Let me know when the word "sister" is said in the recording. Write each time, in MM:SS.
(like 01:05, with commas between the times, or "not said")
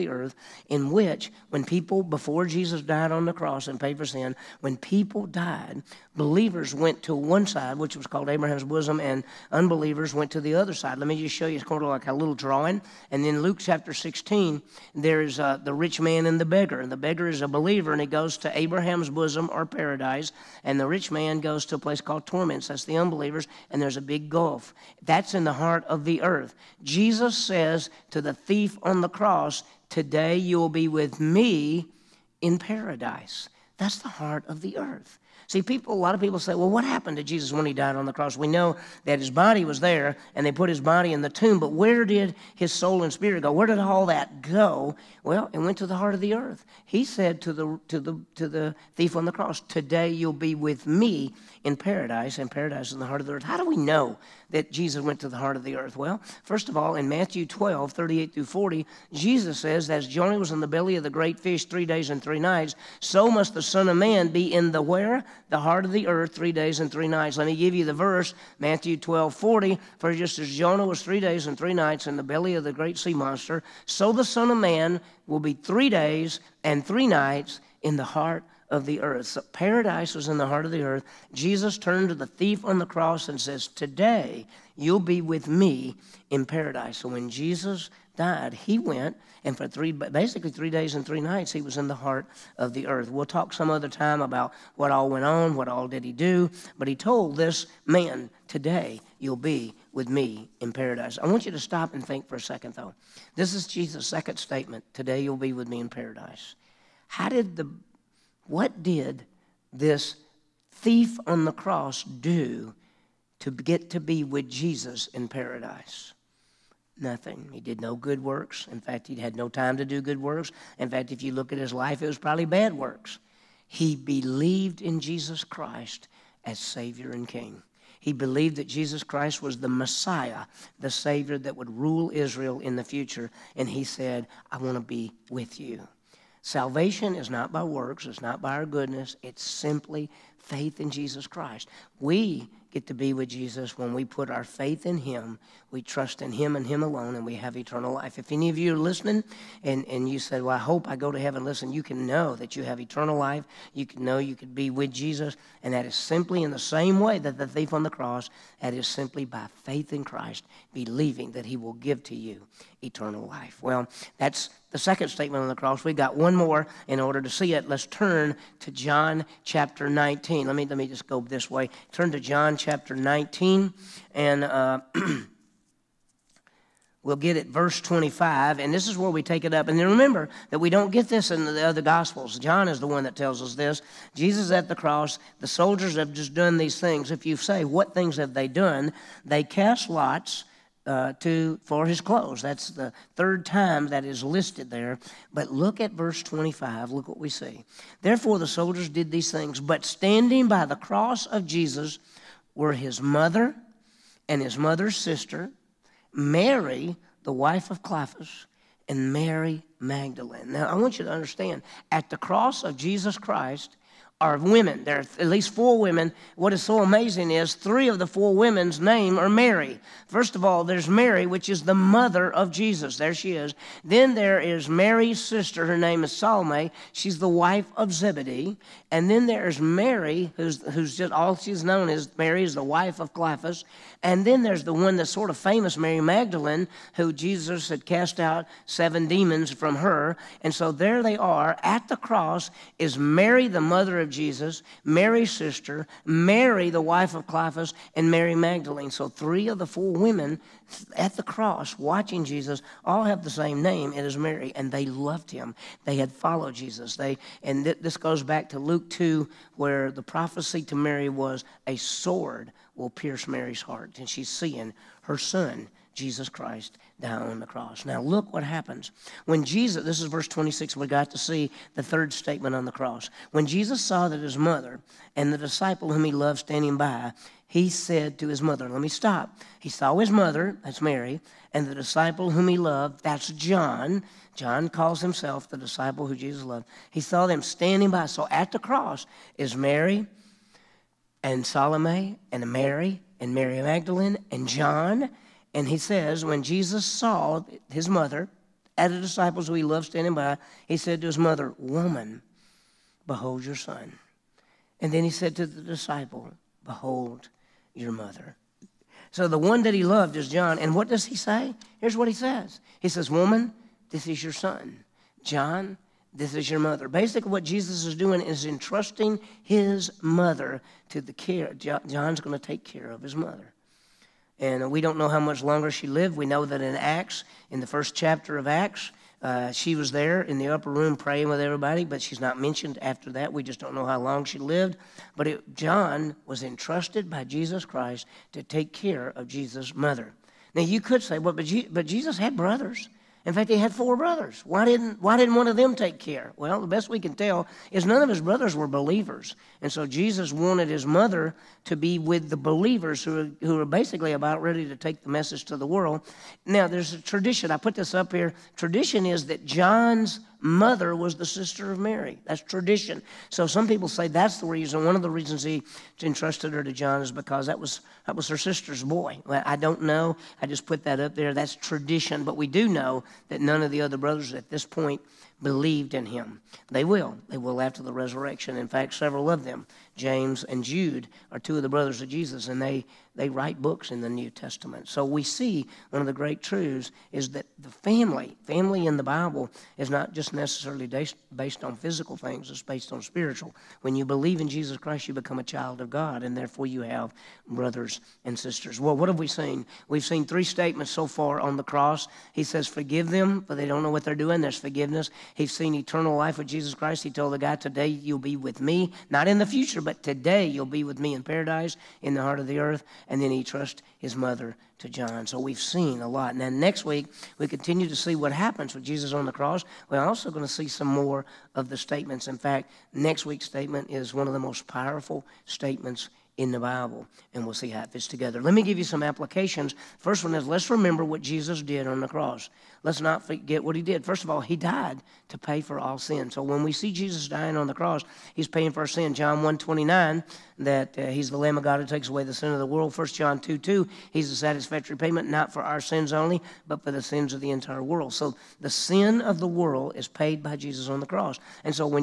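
03:24, 03:45, 04:05, 06:01, 06:08, 06:38.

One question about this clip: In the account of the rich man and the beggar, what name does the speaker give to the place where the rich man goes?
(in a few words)
Torments.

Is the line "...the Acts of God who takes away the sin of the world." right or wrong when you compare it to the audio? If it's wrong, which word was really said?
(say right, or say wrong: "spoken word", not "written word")
wrong: "Lamb", not "Acts".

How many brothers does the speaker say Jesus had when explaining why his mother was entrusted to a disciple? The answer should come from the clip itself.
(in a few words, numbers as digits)
4.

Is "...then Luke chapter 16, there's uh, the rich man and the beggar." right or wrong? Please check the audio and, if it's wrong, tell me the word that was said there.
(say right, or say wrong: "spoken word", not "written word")
right.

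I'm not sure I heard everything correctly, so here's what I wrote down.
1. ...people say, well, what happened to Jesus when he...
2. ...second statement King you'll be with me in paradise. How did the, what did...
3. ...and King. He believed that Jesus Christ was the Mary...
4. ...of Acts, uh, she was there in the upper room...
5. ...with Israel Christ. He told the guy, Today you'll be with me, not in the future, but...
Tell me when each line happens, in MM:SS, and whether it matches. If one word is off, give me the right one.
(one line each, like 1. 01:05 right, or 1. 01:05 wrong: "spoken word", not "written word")
1. 00:36 right
2. 01:44 wrong: "Today", not "King"
3. 02:07 wrong: "Messiah", not "Mary"
4. 05:28 right
5. 06:46 wrong: "Jesus", not "Israel".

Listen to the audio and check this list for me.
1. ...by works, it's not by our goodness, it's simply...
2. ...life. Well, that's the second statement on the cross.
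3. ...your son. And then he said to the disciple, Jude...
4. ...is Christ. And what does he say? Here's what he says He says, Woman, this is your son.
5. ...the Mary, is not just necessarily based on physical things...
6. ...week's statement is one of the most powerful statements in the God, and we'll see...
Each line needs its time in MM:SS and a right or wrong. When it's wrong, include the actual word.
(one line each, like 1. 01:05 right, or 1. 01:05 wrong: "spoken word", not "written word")
1. 02:17 right
2. 02:43 right
3. 05:03 wrong: "Behold", not "Jude"
4. 05:10 wrong: "John", not "Christ"
5. 06:28 wrong: "Bible", not "Mary"
6. 07:03 wrong: "Bible", not "God".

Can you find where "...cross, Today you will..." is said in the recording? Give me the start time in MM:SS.
00:29.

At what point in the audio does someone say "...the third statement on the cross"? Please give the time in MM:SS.
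04:31.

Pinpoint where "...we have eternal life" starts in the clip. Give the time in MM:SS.
02:27.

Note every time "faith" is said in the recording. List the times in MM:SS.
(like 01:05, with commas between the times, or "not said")
02:20, 02:24, 02:39.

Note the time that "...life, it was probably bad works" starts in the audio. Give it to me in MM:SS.
02:01.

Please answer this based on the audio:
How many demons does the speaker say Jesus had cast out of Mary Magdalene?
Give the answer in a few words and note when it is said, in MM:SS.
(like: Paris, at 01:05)
7, at 03:58.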